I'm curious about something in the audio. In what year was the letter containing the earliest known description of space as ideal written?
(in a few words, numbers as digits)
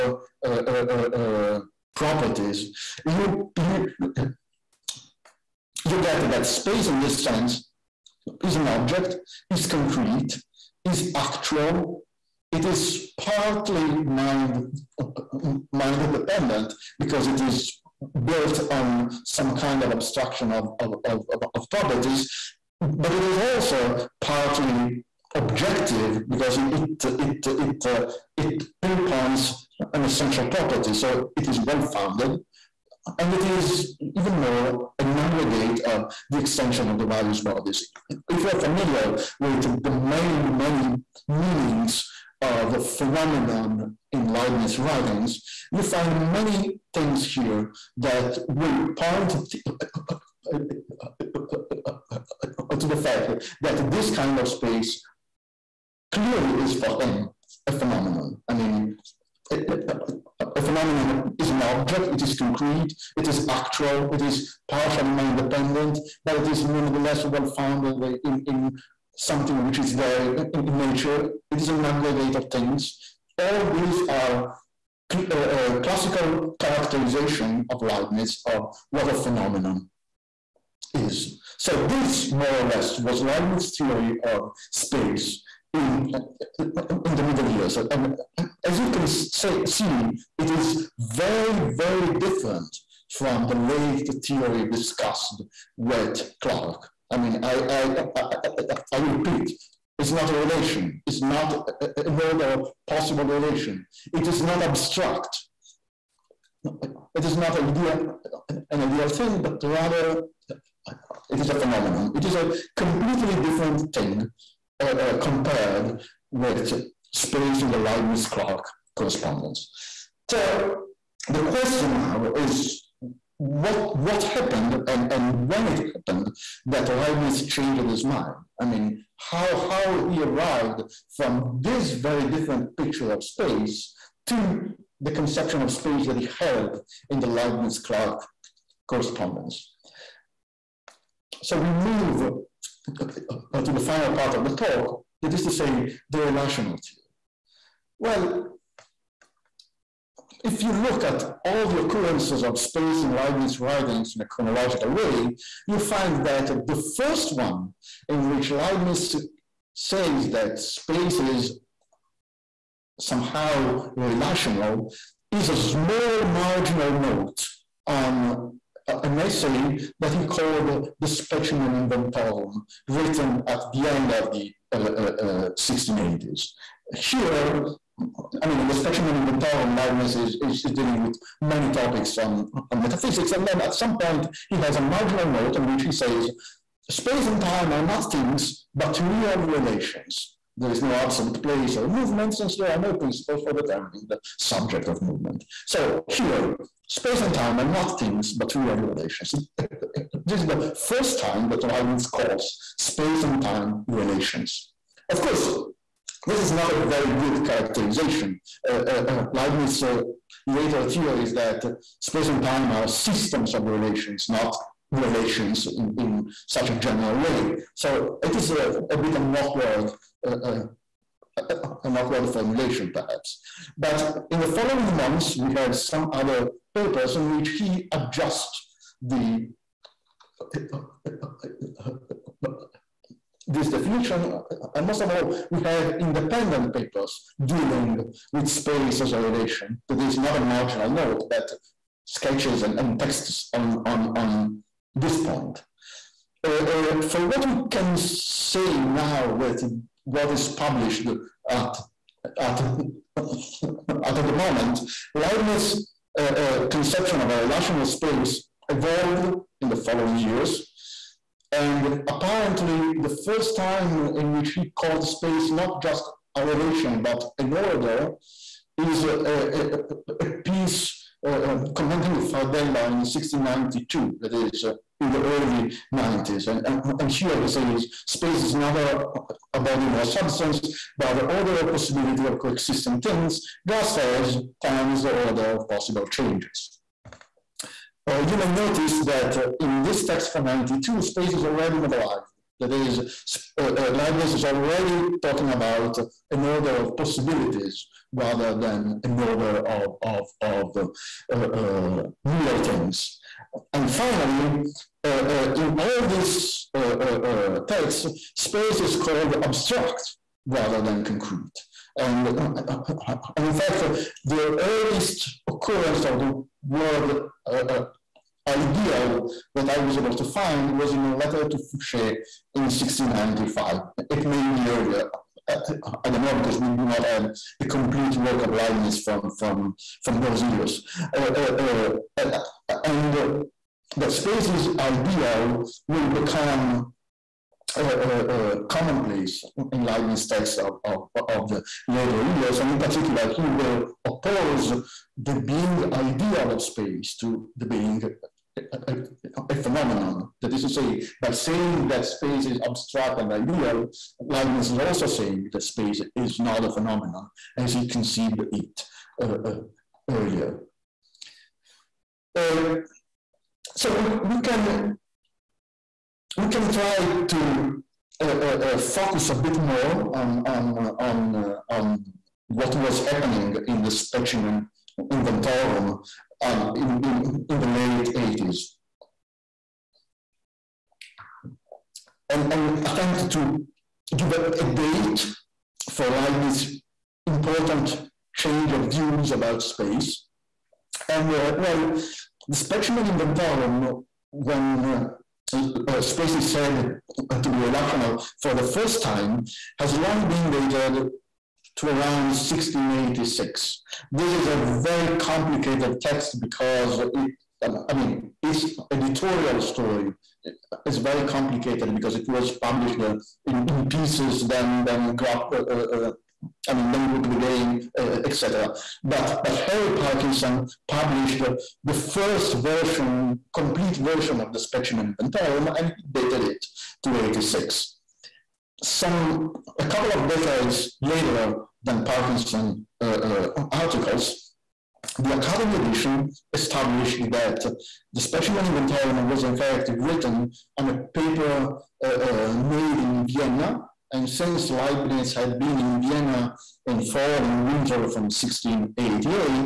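1695.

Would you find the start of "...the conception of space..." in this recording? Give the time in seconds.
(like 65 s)
134 s.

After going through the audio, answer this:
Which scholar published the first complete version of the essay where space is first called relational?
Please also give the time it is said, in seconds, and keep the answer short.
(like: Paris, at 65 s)
Harry Parkinson, at 419 s.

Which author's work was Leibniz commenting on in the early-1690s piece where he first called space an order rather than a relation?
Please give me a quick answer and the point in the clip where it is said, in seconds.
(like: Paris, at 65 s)
Fardella, at 272 s.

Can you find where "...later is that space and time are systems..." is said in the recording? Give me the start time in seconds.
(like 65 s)
210 s.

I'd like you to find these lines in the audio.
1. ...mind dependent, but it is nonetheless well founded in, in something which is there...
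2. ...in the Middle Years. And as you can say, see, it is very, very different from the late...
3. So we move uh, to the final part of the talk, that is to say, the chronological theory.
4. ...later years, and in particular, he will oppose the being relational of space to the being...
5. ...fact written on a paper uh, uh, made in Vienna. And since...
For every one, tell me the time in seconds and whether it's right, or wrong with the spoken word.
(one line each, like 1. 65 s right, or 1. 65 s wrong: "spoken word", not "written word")
1. 65 s right
2. 87 s right
3. 141 s wrong: "relational", not "chronological"
4. 341 s wrong: "ideal", not "relational"
5. 439 s right.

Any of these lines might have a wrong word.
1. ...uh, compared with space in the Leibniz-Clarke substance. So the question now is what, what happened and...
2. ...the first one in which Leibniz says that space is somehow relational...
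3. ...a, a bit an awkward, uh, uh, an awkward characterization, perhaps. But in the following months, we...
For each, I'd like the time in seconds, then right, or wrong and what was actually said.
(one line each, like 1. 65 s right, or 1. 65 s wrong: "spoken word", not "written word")
1. 114 s wrong: "correspondence", not "substance"
2. 156 s right
3. 218 s wrong: "formulation", not "characterization".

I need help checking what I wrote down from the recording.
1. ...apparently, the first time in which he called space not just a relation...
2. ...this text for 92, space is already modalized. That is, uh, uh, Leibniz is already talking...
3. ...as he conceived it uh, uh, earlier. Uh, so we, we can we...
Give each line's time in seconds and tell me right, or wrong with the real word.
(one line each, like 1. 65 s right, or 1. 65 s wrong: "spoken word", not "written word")
1. 262 s right
2. 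289 s right
3. 357 s right.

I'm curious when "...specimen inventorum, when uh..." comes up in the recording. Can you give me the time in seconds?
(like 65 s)
392 s.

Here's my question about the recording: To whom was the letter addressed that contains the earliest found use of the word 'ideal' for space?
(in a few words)
Foucher.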